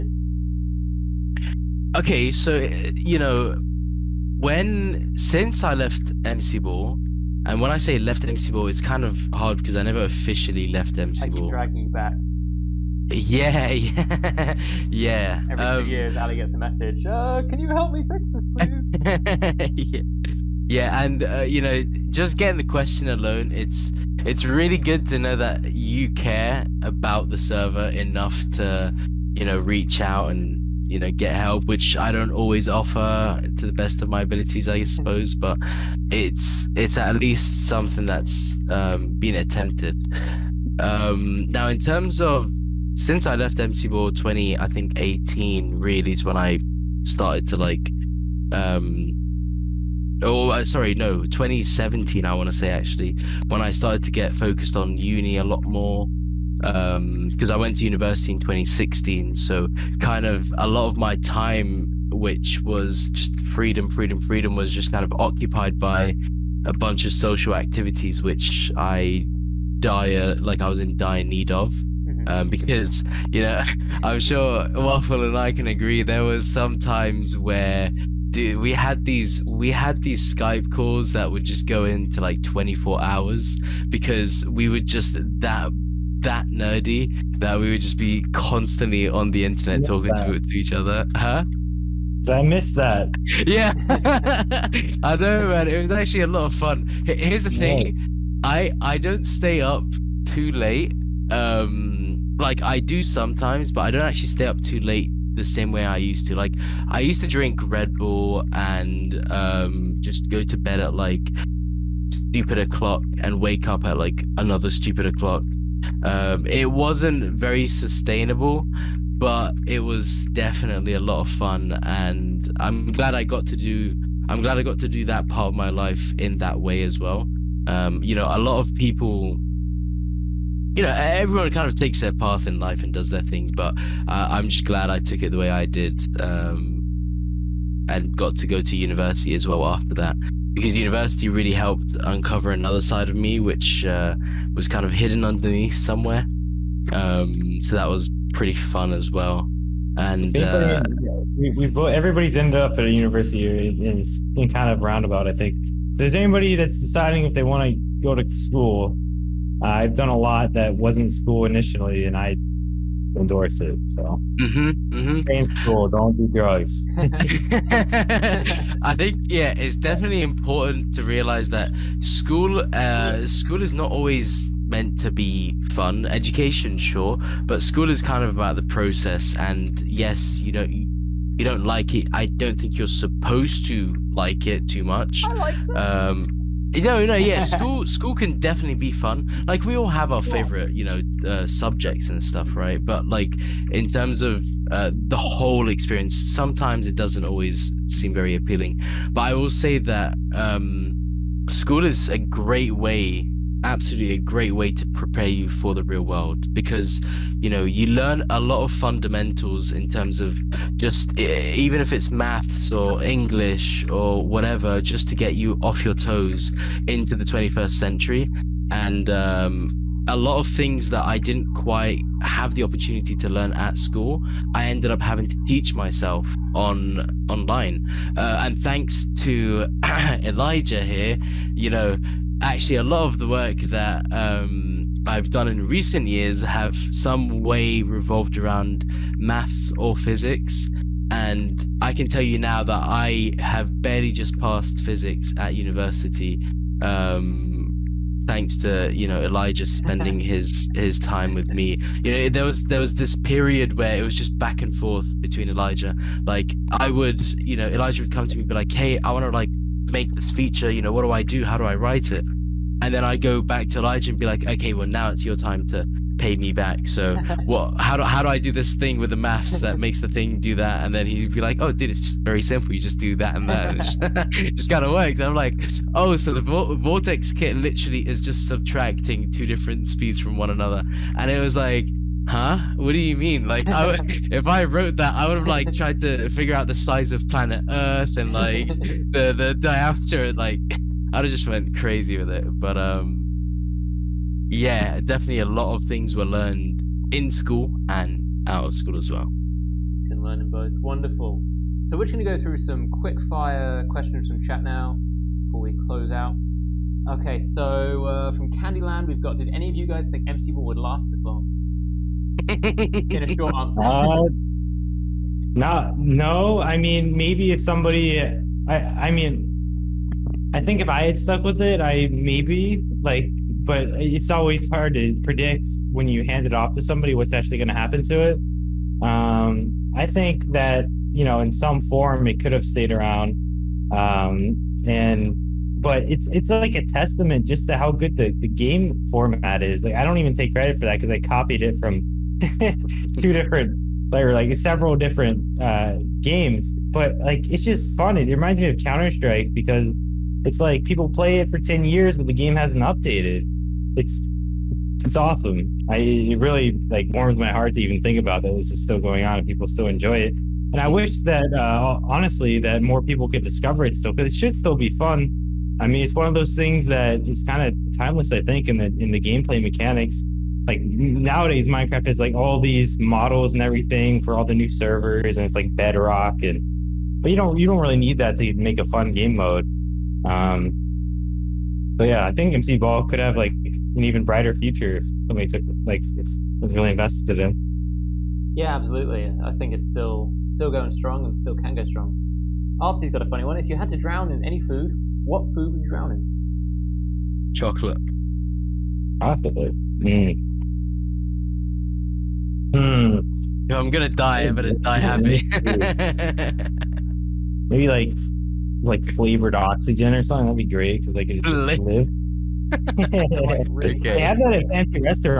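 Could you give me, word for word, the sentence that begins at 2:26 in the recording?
Um, so that was pretty fun as well.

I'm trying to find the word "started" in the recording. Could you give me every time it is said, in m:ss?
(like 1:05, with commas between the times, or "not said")
0:47, 0:53.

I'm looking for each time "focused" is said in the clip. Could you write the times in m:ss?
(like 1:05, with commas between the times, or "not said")
0:54.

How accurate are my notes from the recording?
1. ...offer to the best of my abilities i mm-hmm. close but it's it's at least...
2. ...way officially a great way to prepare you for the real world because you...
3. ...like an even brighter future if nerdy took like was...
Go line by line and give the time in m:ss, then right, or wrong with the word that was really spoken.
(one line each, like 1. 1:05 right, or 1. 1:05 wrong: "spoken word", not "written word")
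1. 0:32 wrong: "suppose", not "close"
2. 3:22 wrong: "absolutely", not "officially"
3. 6:23 wrong: "somebody", not "nerdy".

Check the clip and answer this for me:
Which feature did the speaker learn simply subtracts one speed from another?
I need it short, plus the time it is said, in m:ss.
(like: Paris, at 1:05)
Vortex kit, at 4:36.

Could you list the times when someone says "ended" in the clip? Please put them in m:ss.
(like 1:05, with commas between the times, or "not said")
2:32, 3:44.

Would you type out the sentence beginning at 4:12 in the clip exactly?
You know there was there was this period where it was just back and forth between Elijah.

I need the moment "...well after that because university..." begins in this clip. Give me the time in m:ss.
2:19.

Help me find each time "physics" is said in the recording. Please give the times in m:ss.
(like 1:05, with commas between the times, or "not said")
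3:59, 4:04.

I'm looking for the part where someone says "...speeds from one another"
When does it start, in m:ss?
4:39.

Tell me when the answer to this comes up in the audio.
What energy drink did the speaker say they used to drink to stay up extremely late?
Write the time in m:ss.
1:47.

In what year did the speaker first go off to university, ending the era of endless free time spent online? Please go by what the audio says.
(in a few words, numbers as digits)
2016.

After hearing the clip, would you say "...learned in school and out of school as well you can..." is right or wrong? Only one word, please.
right.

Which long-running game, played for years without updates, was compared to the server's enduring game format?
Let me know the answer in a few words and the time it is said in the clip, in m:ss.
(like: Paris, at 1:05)
Counter Strike, at 5:48.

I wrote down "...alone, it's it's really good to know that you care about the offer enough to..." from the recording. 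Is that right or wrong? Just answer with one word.
wrong.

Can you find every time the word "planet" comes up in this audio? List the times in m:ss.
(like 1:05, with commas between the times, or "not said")
4:47.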